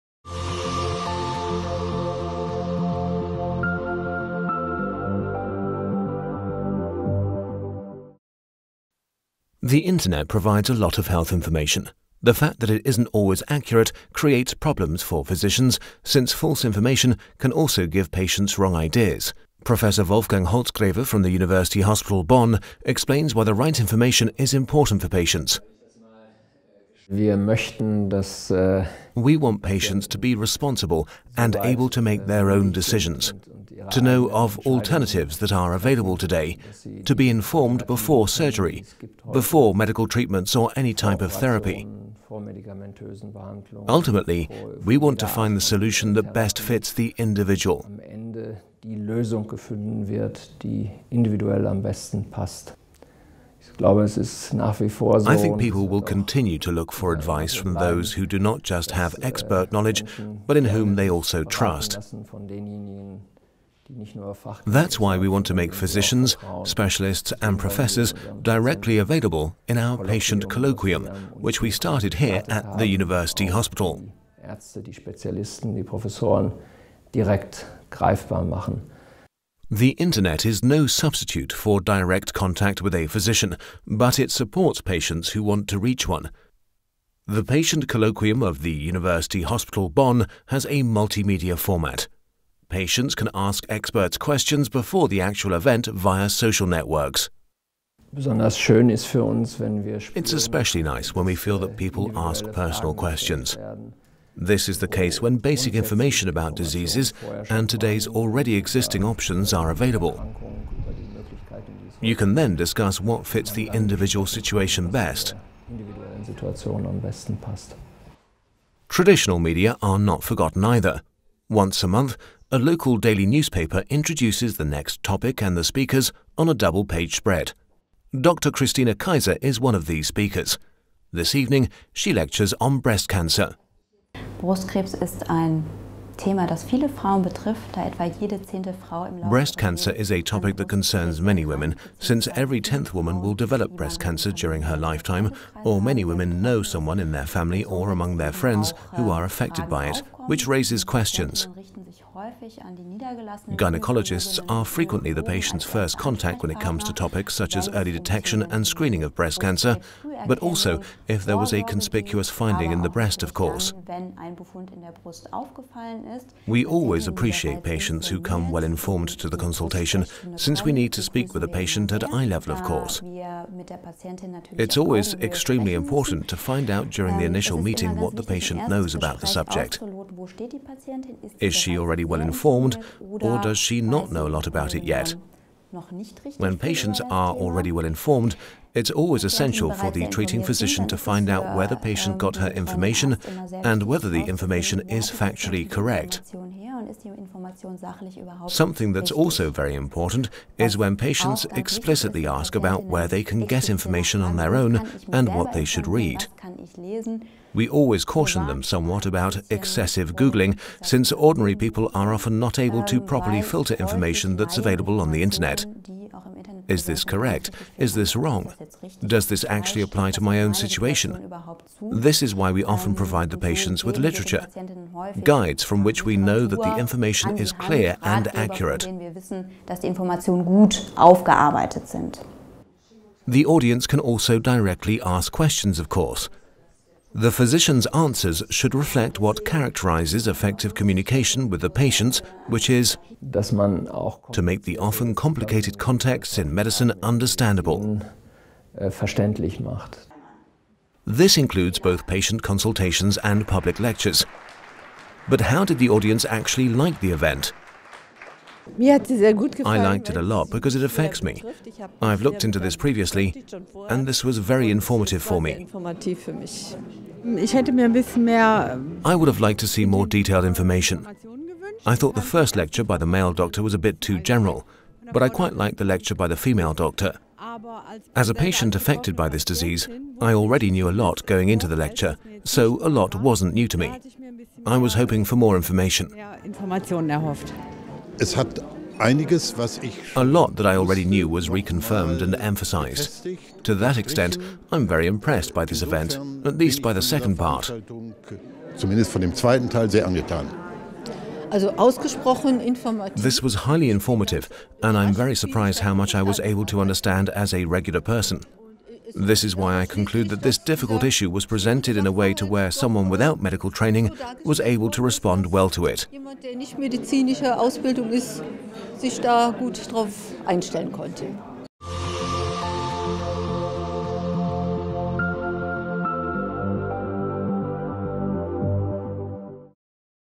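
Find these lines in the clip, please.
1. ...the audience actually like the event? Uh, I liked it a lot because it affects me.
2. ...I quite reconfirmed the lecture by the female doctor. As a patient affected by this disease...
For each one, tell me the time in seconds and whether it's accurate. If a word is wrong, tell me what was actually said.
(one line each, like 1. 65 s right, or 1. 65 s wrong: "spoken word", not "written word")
1. 255 s right
2. 275 s wrong: "liked", not "reconfirmed".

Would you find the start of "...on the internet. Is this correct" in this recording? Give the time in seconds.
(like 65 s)
214 s.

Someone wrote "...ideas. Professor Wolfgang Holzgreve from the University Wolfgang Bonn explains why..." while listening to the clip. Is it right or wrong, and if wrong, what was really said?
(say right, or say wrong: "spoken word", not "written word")
wrong: "Hospital", not "Wolfgang".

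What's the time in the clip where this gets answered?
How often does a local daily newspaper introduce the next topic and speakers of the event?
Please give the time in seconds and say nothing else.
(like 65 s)
121 s.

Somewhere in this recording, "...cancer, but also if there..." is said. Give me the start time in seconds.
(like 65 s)
159 s.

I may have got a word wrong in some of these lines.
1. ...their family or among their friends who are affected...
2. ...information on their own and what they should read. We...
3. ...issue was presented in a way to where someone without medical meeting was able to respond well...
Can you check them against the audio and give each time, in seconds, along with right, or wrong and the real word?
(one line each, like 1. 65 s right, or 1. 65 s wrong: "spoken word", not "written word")
1. 147 s right
2. 203 s right
3. 311 s wrong: "training", not "meeting".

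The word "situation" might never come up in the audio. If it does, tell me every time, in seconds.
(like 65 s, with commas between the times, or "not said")
114 s, 220 s.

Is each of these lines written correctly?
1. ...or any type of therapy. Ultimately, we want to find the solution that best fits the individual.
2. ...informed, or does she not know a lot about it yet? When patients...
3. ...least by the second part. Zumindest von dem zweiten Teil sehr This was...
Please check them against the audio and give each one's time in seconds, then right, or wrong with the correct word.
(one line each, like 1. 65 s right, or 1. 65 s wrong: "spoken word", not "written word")
1. 40 s right
2. 182 s right
3. 296 s right.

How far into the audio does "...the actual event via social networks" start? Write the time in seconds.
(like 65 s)
95 s.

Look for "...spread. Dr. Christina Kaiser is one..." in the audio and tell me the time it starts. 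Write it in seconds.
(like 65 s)
127 s.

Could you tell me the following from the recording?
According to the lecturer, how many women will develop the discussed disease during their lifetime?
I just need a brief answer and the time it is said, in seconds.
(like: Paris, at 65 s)
Every tenth woman, at 142 s.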